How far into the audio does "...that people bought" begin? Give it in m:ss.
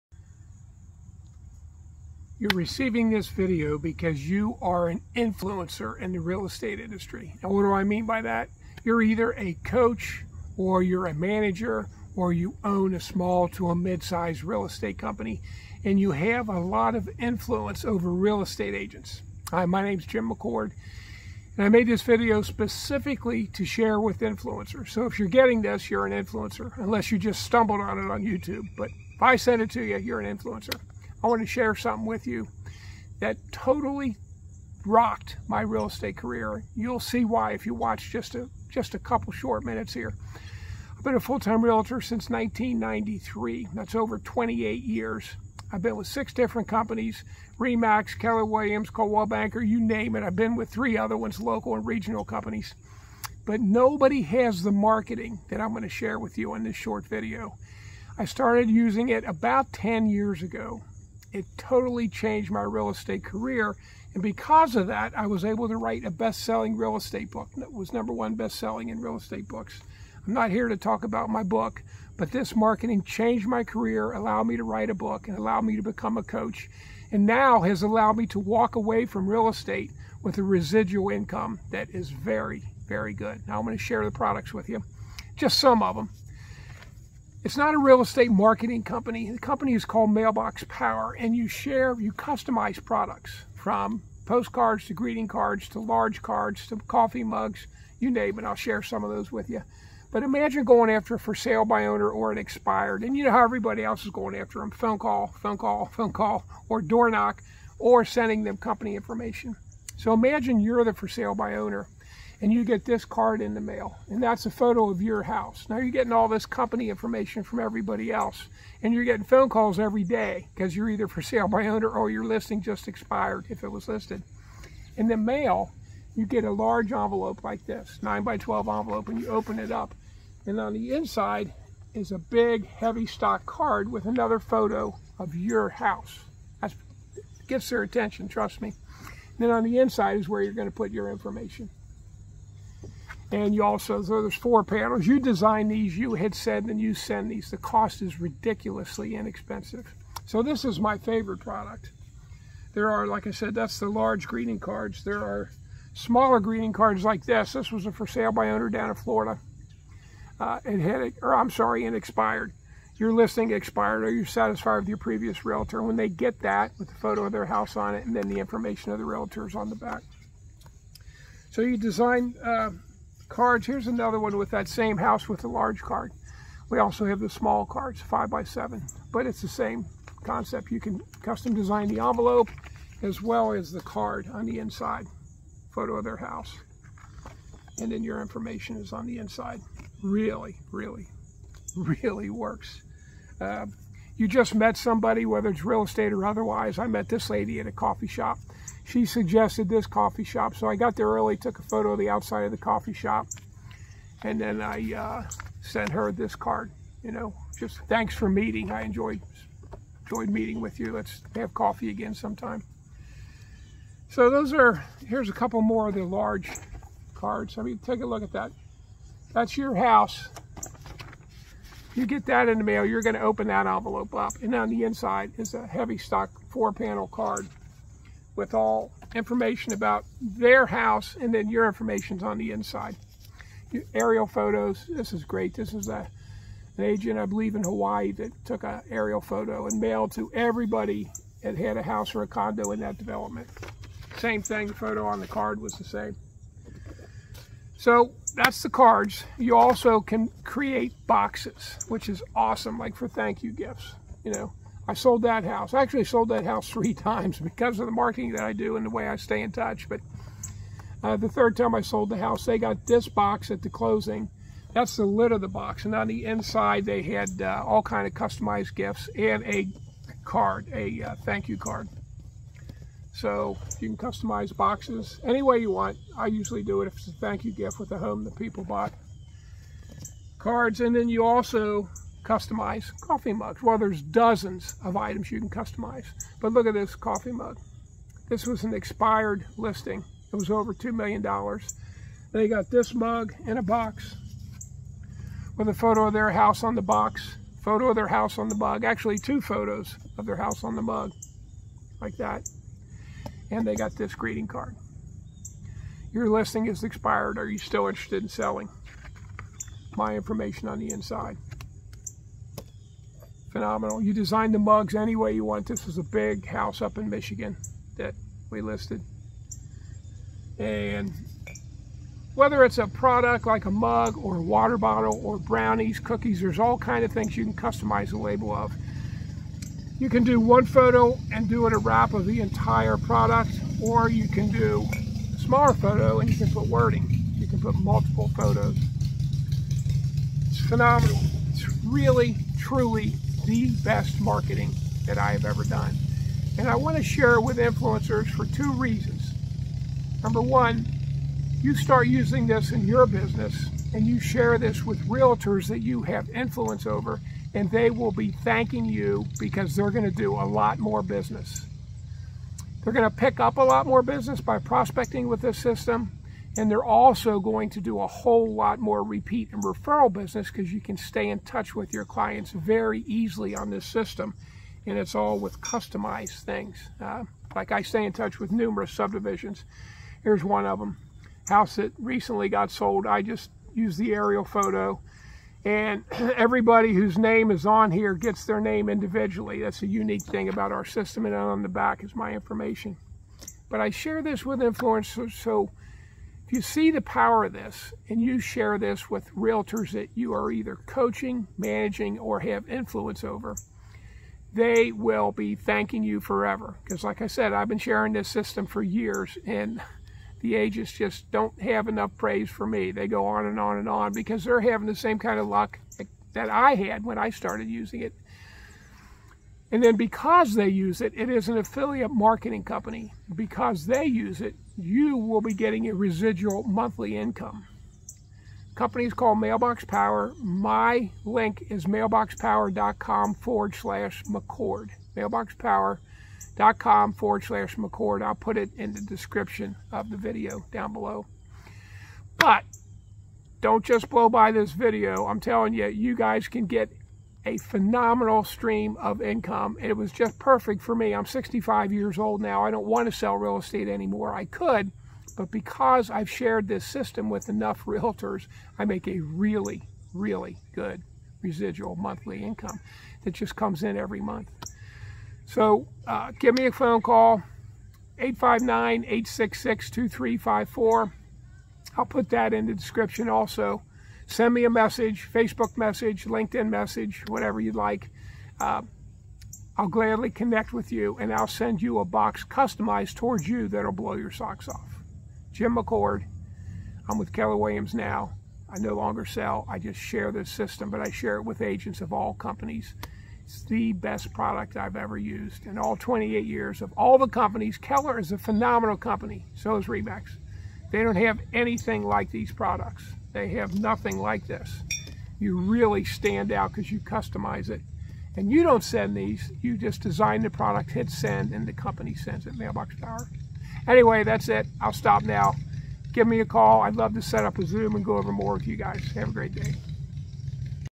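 4:38.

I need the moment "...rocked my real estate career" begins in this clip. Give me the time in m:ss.
0:34.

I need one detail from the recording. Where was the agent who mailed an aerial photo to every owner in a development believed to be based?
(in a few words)
Hawaii.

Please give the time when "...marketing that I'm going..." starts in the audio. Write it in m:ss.
0:54.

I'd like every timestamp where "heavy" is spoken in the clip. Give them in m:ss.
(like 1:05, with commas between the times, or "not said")
2:12, 3:45.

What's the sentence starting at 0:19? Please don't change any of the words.
Hi, my name's Jim McCord and I made this video specifically to share with influencers.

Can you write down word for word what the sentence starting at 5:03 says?
And they got this greeting card.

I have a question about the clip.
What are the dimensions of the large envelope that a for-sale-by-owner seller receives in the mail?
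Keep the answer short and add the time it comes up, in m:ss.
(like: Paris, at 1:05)
9 by 12, at 2:08.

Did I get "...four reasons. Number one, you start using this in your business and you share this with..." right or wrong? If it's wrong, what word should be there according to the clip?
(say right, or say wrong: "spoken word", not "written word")
wrong: "two", not "four".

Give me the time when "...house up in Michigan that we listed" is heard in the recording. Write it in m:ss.
5:16.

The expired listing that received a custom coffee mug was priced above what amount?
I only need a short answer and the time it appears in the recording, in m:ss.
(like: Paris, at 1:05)
$2 million, at 4:50.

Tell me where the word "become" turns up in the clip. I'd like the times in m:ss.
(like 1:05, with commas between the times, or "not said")
1:15.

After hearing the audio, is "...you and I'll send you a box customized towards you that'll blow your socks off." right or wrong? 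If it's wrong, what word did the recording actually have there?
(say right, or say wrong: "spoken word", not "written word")
right.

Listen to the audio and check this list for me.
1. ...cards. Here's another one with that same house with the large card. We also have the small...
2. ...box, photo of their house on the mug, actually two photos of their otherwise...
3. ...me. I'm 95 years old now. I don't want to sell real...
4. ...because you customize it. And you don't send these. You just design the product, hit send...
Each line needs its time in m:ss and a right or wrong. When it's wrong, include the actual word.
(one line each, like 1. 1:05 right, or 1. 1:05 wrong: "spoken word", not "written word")
1. 2:53 right
2. 4:56 wrong: "house", not "otherwise"
3. 7:30 wrong: "65", not "95"
4. 8:26 right.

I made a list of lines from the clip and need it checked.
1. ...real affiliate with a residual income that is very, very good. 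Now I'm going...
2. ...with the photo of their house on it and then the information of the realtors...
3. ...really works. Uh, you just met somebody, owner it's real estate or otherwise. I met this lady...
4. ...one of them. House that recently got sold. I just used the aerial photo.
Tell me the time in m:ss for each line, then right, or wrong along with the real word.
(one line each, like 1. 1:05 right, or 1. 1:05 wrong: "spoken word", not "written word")
1. 1:19 wrong: "estate", not "affiliate"
2. 2:46 right
3. 3:11 wrong: "whether", not "owner"
4. 6:20 right.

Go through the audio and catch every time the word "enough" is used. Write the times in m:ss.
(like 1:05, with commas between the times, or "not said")
6:51, 7:37.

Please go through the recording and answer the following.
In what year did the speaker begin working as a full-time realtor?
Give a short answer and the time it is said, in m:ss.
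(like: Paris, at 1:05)
1993, at 0:42.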